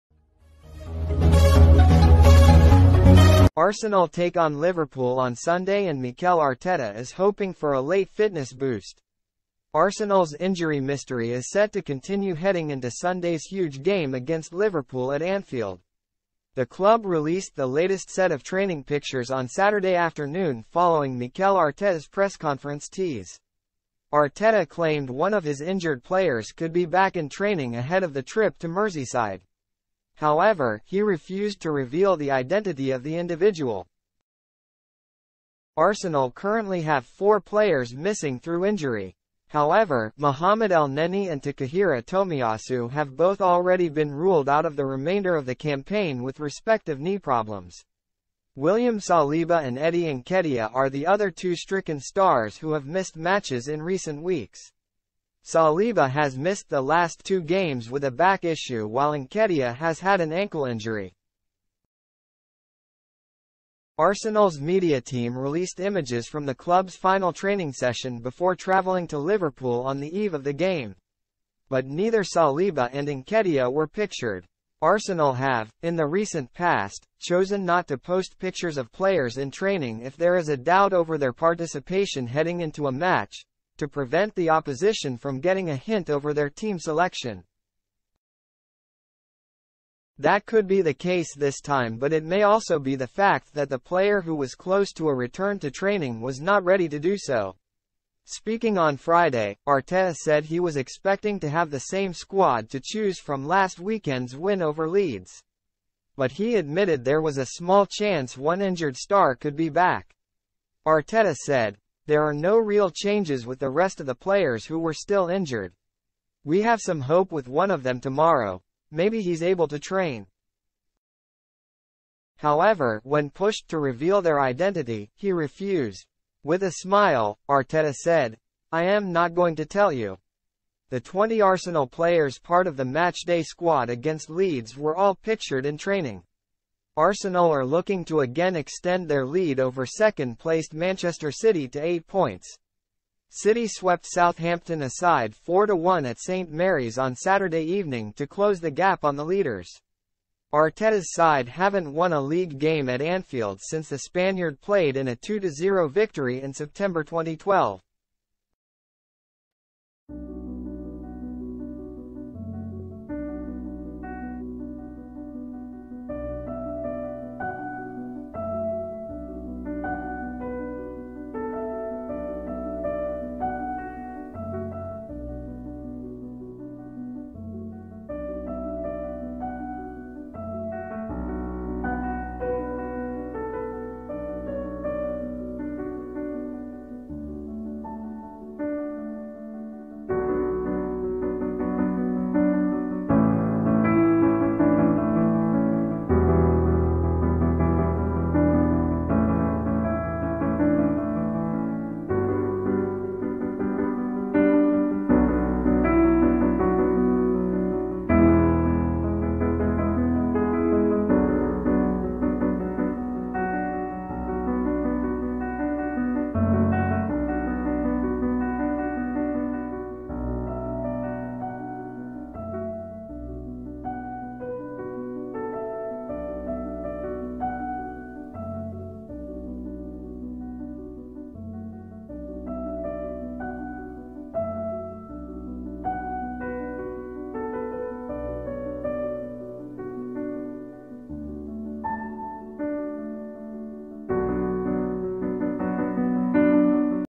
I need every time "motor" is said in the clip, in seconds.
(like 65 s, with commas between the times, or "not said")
not said.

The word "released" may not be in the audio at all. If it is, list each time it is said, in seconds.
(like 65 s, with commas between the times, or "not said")
17 s, 65 s.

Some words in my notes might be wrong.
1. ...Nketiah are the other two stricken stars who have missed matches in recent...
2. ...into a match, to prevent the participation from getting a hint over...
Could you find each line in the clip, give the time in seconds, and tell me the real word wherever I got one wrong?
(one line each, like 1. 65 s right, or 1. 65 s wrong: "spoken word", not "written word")
1. 50 s right
2. 82 s wrong: "opposition", not "participation".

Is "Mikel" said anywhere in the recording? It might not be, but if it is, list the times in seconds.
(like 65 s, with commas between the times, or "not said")
6 s, 21 s.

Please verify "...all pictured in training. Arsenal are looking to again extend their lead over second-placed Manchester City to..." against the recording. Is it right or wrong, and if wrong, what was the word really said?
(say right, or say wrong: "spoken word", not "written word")
right.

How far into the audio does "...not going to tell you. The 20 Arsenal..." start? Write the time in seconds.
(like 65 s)
129 s.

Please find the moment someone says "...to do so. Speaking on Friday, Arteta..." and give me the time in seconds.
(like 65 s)
96 s.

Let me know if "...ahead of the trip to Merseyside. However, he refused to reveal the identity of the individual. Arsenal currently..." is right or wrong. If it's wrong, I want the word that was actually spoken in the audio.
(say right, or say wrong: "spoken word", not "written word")
right.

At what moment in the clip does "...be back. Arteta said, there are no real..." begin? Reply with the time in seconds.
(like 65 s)
109 s.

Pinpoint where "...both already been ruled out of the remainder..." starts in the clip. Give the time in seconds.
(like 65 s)
43 s.